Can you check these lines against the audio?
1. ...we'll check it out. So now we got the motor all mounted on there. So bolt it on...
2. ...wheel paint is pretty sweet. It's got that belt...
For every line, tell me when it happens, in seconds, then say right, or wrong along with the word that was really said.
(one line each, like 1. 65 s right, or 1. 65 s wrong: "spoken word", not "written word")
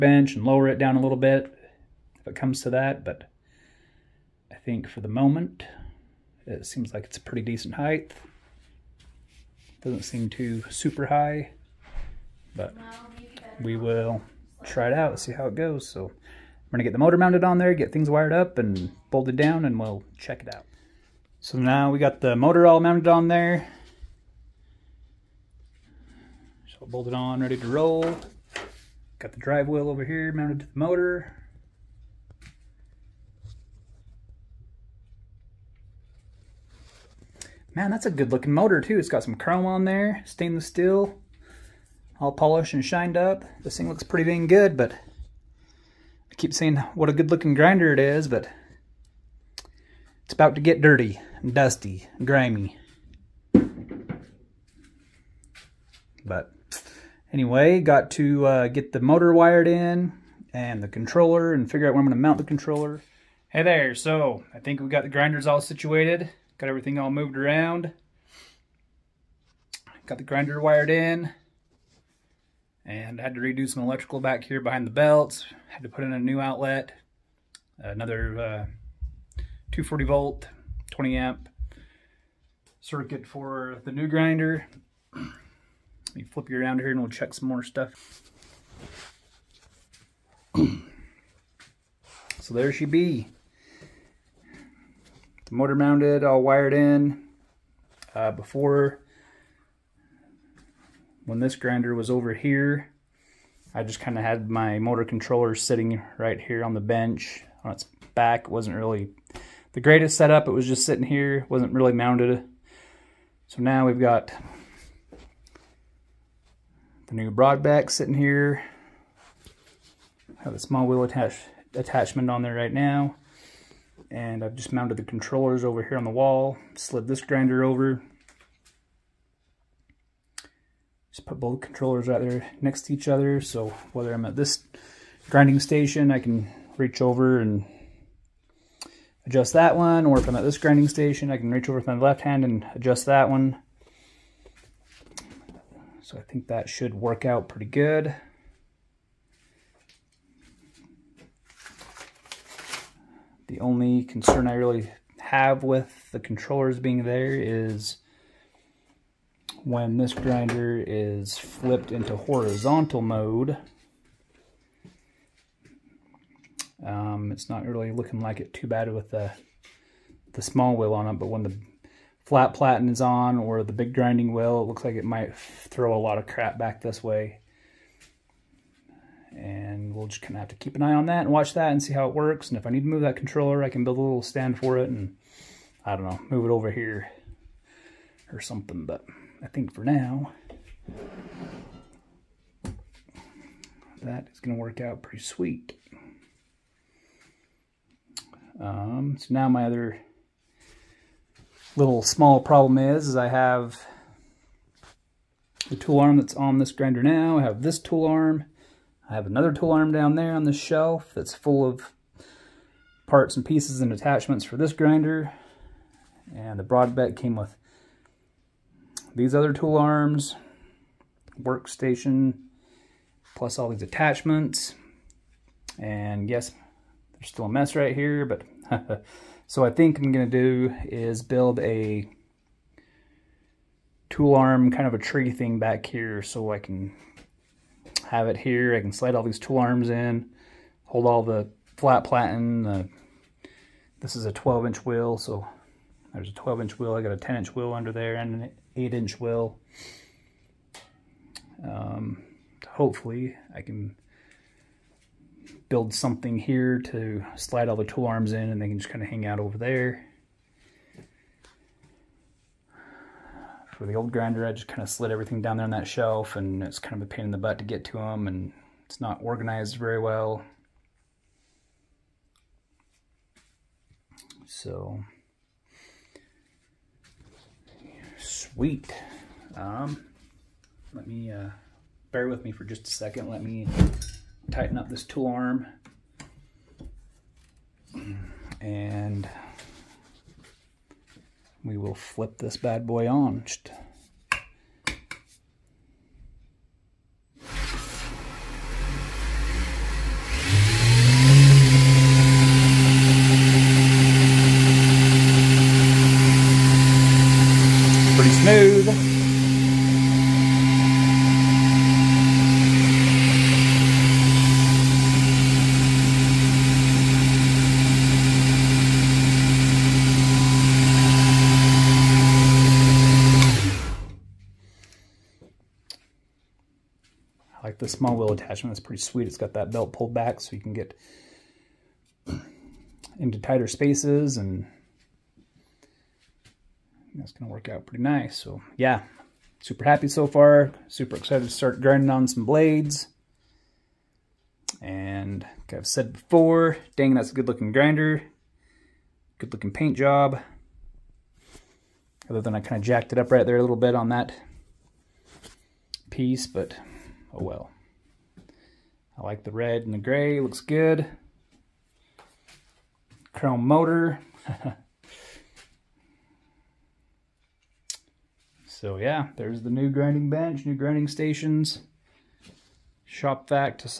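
1. 19 s right
2. 328 s wrong: "attachment", not "paint".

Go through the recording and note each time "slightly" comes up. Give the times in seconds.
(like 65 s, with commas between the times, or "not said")
not said.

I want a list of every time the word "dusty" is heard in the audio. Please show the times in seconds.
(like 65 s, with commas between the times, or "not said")
51 s.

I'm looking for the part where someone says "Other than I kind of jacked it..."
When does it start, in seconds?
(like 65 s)
352 s.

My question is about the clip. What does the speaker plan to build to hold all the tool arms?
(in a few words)
a tree.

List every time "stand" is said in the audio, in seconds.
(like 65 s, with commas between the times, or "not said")
184 s.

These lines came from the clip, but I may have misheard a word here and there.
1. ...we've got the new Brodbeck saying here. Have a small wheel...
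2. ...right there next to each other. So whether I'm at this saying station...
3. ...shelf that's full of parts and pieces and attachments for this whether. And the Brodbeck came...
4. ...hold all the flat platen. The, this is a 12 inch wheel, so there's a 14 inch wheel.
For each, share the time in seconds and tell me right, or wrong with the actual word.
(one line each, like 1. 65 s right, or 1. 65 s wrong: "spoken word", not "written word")
1. 113 s wrong: "sitting", not "saying"
2. 132 s wrong: "grinding", not "saying"
3. 210 s wrong: "grinder", not "whether"
4. 240 s wrong: "12", not "14".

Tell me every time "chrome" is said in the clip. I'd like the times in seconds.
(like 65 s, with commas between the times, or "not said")
39 s, 363 s.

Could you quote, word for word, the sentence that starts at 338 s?
So yeah, super happy so far.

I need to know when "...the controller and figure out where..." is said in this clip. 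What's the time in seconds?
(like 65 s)
60 s.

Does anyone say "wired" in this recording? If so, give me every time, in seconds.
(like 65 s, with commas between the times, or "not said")
18 s, 59 s, 70 s, 96 s.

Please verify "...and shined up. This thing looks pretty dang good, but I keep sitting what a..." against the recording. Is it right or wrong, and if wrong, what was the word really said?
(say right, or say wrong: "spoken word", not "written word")
wrong: "saying", not "sitting".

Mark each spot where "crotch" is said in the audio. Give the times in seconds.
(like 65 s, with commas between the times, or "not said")
not said.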